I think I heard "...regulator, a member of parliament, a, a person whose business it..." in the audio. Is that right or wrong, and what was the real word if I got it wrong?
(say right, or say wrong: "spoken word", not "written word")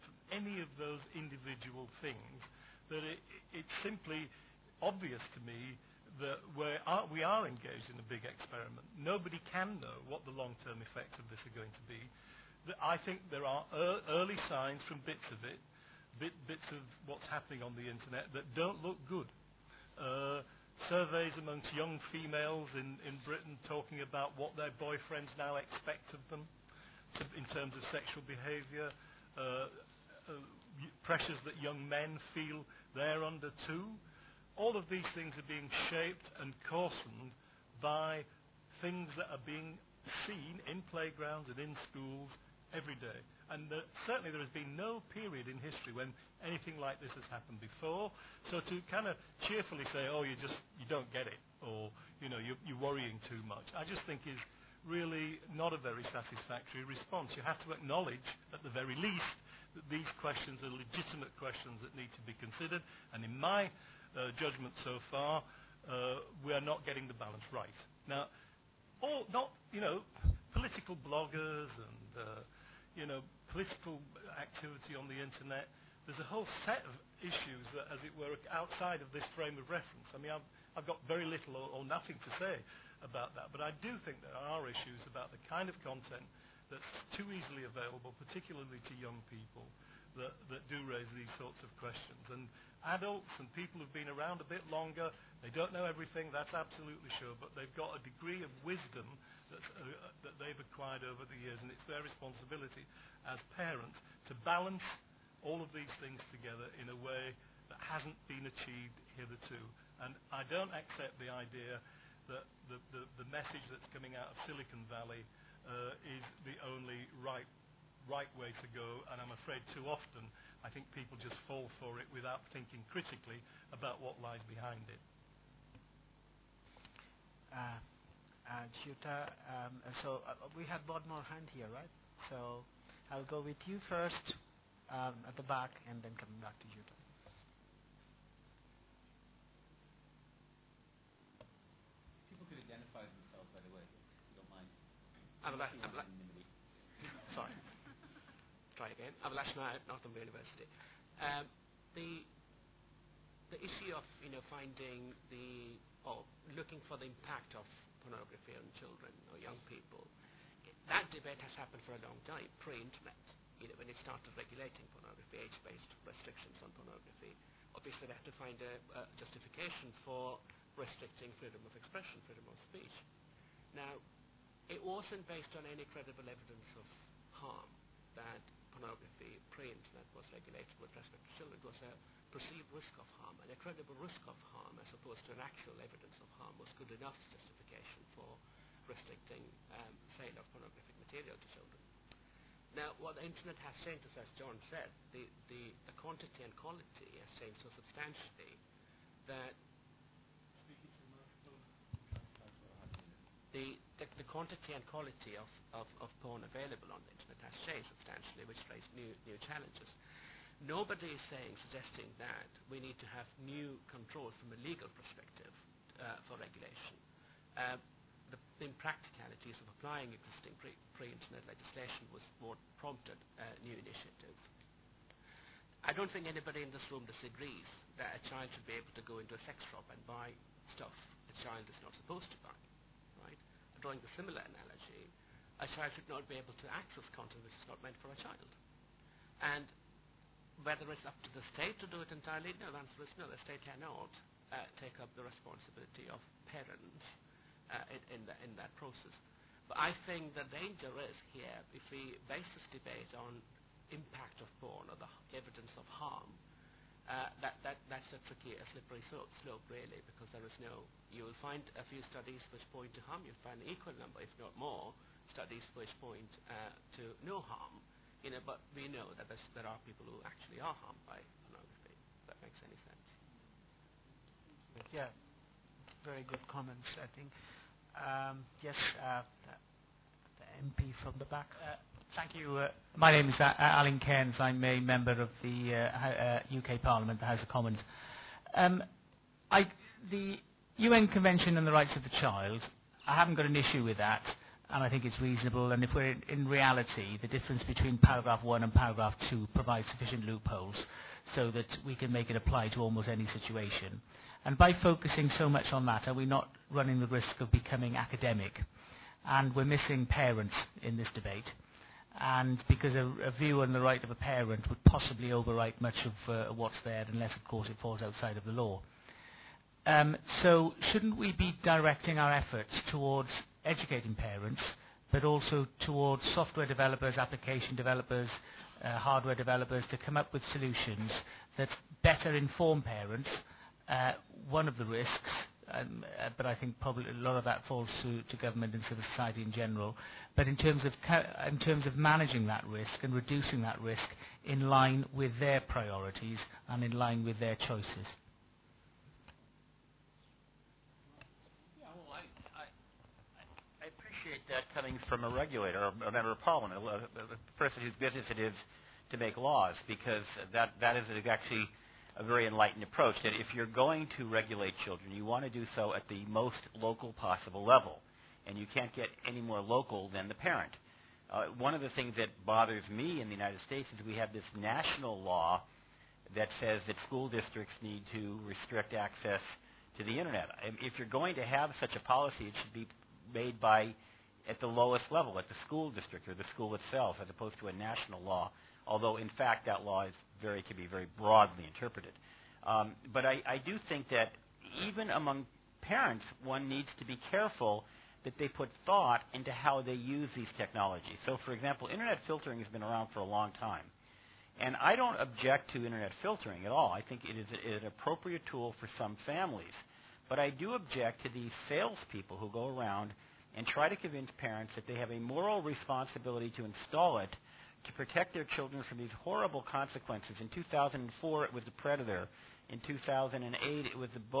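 right.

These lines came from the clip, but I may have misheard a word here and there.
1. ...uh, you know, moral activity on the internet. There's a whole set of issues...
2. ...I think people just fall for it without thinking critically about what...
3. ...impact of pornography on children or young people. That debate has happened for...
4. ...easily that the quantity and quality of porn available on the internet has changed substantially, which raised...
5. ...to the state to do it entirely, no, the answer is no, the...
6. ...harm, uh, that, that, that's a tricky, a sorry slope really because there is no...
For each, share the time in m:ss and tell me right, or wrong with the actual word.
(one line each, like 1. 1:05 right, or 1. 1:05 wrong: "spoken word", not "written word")
1. 1:12 wrong: "political", not "moral"
2. 2:00 right
3. 2:37 right
4. 3:17 wrong: "substantially", not "easily"
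5. 4:01 right
6. 4:15 wrong: "slippery", not "sorry".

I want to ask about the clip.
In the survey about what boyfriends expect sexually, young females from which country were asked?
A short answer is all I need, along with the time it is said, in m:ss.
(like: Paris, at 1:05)
Britain, at 0:23.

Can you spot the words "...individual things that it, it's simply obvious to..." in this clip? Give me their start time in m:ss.
0:01.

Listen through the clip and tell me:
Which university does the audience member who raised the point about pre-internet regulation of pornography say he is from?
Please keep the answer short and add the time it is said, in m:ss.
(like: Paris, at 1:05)
Northumbria University, at 2:29.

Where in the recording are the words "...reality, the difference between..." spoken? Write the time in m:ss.
4:56.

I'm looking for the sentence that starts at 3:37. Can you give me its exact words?
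Uh, the impracticalities of applying existing pre-internet legislation was what prompted uh, new initiatives.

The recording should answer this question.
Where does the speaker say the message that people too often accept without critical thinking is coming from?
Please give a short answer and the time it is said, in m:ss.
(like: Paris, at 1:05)
Silicon Valley, at 1:54.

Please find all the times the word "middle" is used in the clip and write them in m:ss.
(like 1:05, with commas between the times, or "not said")
not said.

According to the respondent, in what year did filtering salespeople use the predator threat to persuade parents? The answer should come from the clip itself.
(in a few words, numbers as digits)
2004.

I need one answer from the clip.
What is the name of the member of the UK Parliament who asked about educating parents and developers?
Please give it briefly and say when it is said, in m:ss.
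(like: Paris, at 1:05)
Alun Cairns, at 4:43.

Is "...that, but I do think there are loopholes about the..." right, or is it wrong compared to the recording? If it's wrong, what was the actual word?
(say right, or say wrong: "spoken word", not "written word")
wrong: "issues", not "loopholes".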